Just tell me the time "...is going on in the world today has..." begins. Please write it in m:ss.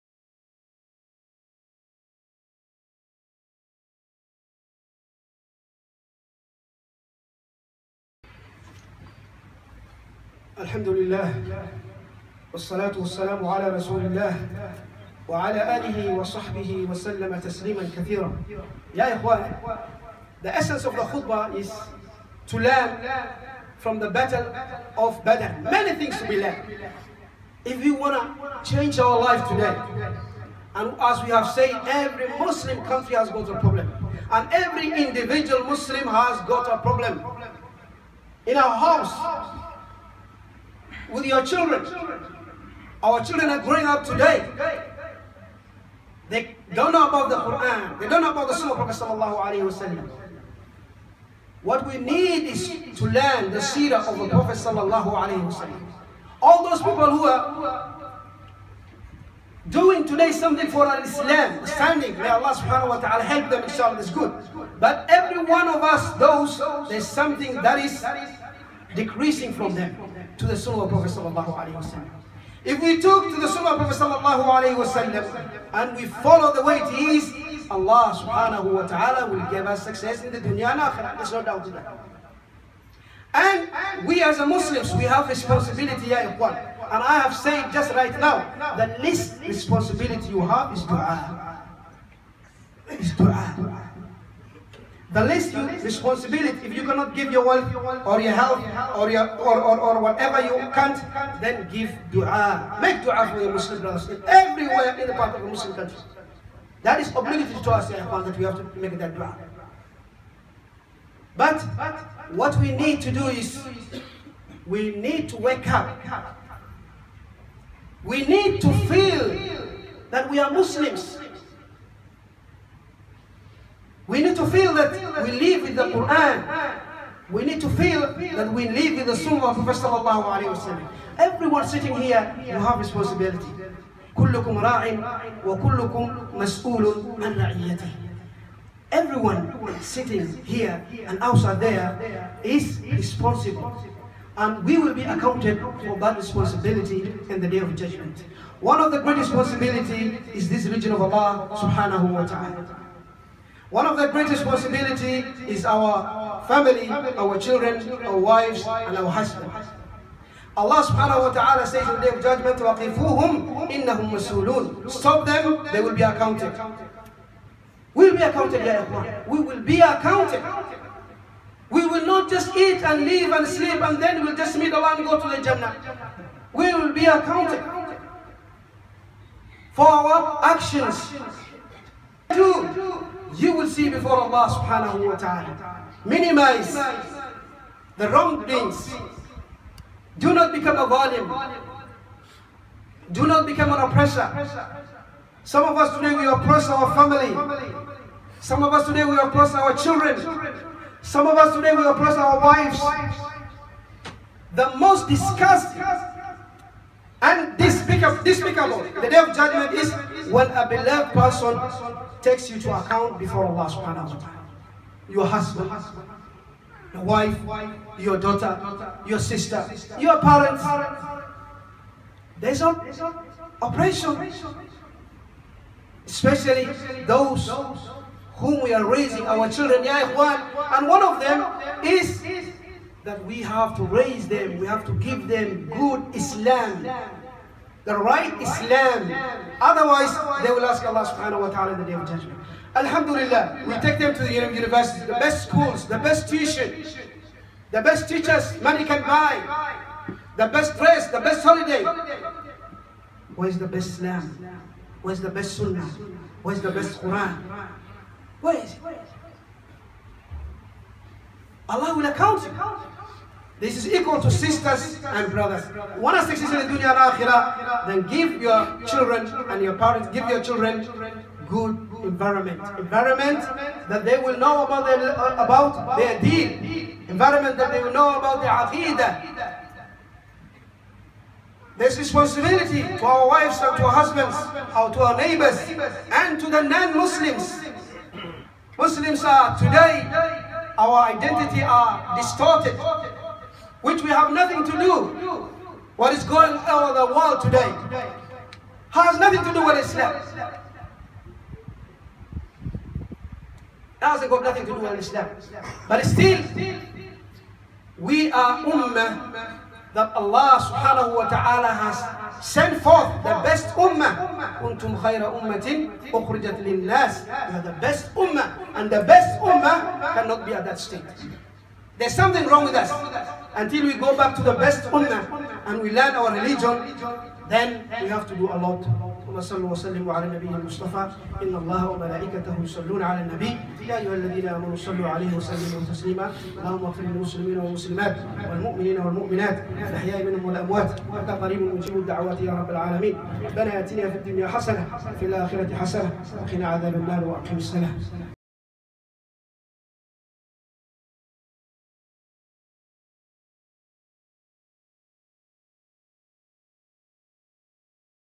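4:56.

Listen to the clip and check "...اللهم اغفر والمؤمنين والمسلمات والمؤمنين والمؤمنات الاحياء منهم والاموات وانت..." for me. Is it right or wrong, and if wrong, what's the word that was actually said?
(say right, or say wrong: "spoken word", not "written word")
wrong: "للمسلمين", not "والمؤمنين".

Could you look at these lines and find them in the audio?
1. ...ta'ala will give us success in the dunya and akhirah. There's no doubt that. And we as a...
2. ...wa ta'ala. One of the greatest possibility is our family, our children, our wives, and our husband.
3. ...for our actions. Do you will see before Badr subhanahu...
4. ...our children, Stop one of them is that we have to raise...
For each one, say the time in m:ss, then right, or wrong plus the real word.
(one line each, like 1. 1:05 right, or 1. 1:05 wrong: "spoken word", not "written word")
1. 1:18 right
2. 2:32 right
3. 2:59 wrong: "Allah", not "Badr"
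4. 3:49 wrong: "And", not "Stop".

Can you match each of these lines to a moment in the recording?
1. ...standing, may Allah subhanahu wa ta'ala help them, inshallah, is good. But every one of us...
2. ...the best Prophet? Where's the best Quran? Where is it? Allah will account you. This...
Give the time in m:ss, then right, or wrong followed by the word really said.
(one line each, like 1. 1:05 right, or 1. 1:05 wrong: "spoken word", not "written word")
1. 1:01 right
2. 4:15 wrong: "Sunnah", not "Prophet".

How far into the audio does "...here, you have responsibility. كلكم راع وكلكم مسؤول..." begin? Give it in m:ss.
2:12.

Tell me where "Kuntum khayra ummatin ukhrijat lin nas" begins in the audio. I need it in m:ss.
5:14.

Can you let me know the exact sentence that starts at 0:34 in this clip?
And every individual Muslim has got a problem.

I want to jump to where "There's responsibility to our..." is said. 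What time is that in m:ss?
4:41.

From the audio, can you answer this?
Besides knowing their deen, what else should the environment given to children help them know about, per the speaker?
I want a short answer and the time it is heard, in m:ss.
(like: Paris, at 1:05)
aqidah, at 4:38.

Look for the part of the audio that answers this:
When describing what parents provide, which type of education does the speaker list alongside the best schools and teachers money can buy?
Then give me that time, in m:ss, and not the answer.
4:05.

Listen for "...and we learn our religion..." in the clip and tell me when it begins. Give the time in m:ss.
5:25.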